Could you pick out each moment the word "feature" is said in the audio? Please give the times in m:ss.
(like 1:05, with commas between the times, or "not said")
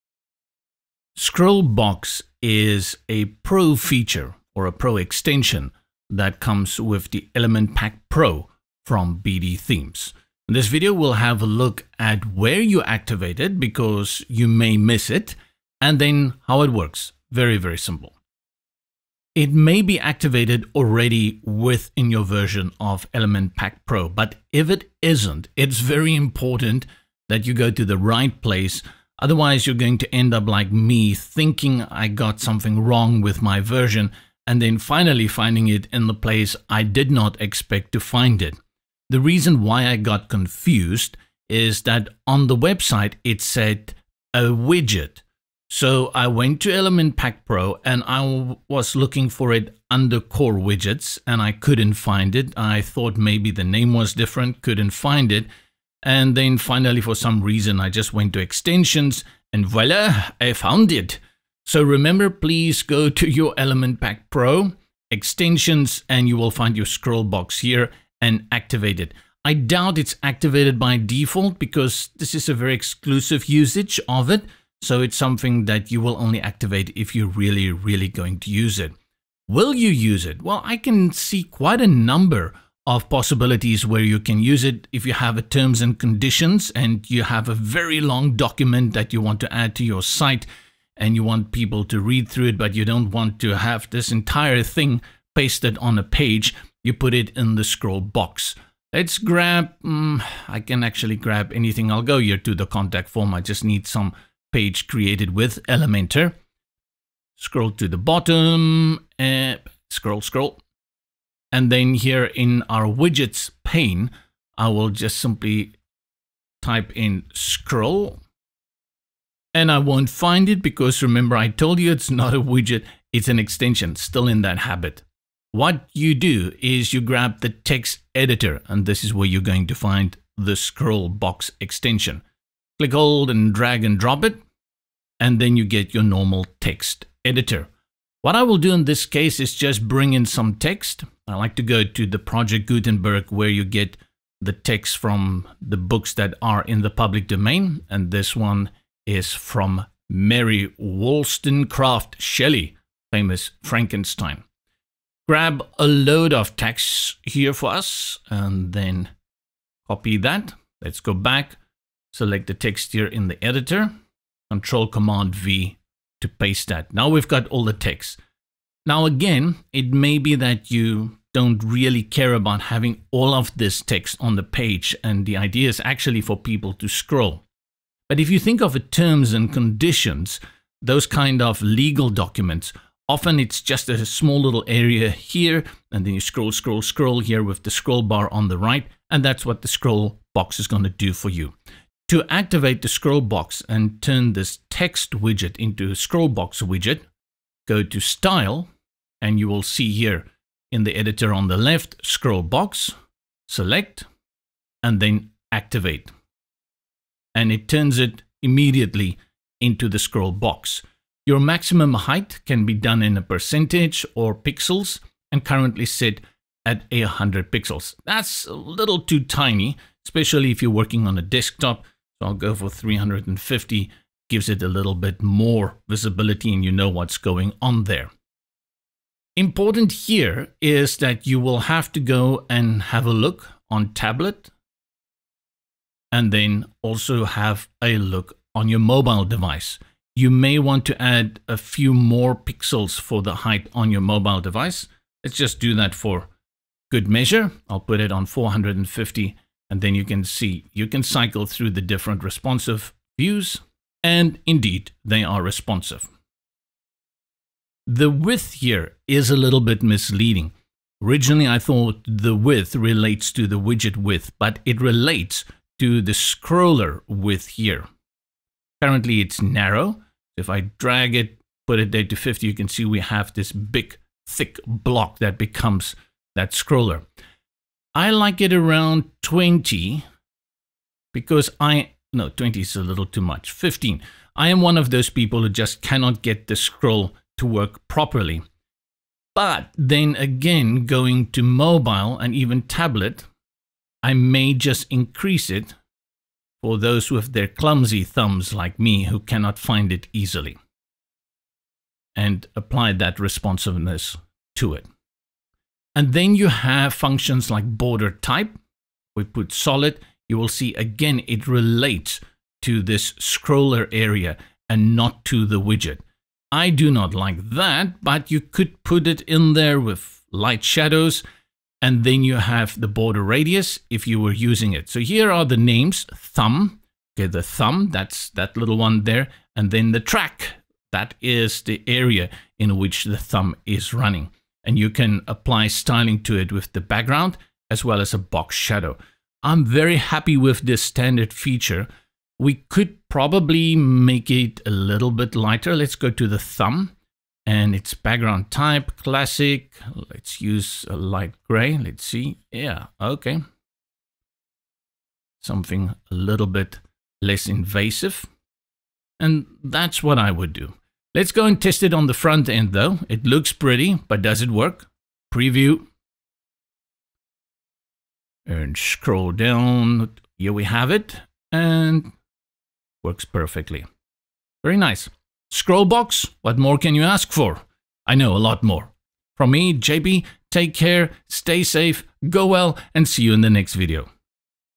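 0:03, 5:41.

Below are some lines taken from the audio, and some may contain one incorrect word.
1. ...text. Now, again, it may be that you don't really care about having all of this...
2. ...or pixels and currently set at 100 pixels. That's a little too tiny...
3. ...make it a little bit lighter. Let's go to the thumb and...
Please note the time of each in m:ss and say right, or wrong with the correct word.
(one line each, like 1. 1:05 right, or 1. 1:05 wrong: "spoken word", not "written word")
1. 2:47 right
2. 3:34 right
3. 5:43 right.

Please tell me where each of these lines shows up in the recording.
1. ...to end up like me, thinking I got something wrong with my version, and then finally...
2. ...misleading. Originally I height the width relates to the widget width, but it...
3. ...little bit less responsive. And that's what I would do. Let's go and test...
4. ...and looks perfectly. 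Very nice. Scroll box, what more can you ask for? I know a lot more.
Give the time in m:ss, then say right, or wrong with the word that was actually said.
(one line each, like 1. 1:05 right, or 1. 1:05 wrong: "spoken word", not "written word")
1. 0:29 right
2. 4:19 wrong: "thought", not "height"
3. 5:56 wrong: "invasive", not "responsive"
4. 6:11 wrong: "works", not "looks".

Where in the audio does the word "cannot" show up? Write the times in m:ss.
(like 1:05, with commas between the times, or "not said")
4:45, 4:59.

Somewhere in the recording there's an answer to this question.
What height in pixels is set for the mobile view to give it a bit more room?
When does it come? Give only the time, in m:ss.
4:08.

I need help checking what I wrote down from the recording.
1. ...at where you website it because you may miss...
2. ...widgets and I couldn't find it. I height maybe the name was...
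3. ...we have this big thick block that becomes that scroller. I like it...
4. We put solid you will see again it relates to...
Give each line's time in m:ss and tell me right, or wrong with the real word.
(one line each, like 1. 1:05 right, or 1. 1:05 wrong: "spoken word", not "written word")
1. 0:11 wrong: "activate", not "website"
2. 0:50 wrong: "thought", not "height"
3. 4:32 right
4. 5:09 right.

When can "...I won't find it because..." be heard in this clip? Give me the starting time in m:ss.
1:59.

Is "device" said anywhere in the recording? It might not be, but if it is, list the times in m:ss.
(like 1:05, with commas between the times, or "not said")
3:59, 4:04.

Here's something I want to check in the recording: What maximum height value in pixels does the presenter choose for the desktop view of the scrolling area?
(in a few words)
350.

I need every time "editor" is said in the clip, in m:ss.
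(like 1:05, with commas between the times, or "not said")
2:08, 2:17, 2:43, 3:20.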